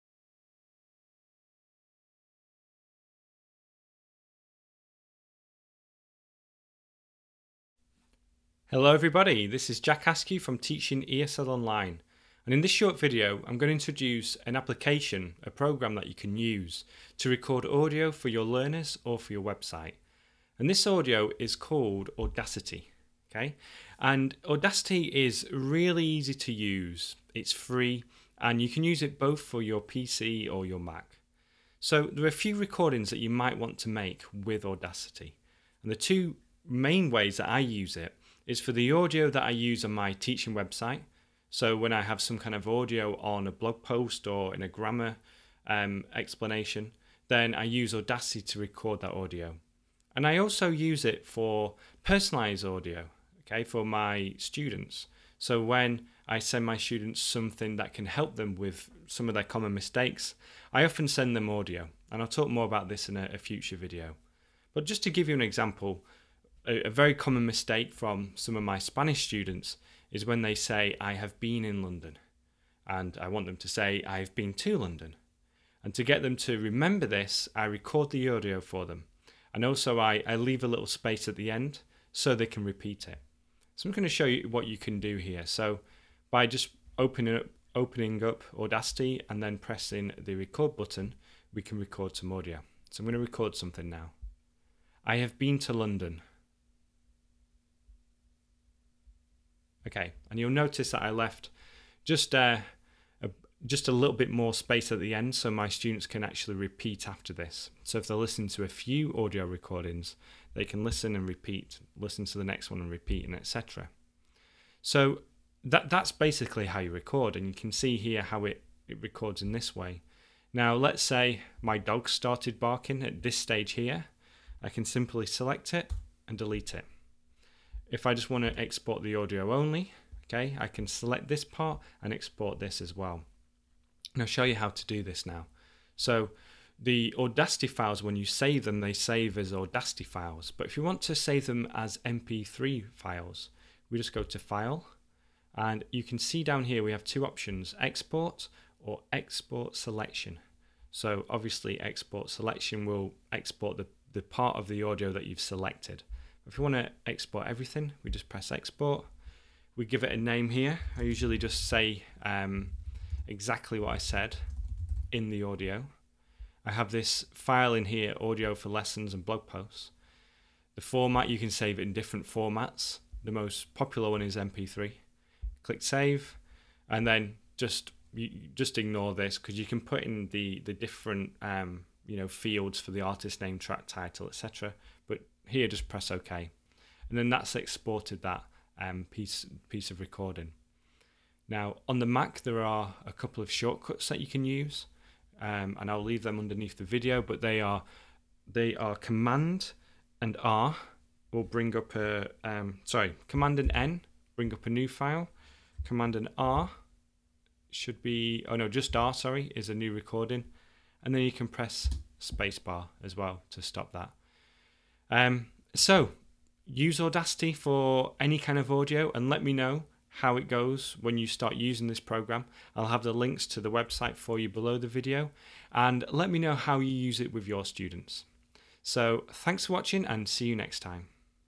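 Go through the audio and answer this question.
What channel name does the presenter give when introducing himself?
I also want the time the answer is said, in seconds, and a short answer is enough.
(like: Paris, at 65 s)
Teaching ESL Online, at 10 s.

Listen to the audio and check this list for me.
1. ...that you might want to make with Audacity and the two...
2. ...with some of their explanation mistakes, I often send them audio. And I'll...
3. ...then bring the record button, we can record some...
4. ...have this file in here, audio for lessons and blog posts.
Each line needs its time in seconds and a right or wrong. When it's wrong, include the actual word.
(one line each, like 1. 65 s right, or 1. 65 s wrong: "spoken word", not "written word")
1. 33 s right
2. 58 s wrong: "common", not "explanation"
3. 89 s wrong: "pressing", not "bring"
4. 166 s right.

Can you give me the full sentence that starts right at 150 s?
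So obviously Export Selection will export the, the part of the audio that you've selected.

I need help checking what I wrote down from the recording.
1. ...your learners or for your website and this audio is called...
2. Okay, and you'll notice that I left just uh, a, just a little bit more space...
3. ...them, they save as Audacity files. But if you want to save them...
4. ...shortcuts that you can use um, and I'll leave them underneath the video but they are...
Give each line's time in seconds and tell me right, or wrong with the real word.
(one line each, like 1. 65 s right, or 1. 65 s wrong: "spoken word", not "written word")
1. 18 s right
2. 99 s right
3. 138 s right
4. 193 s right.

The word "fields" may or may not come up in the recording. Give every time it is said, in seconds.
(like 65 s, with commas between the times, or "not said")
182 s.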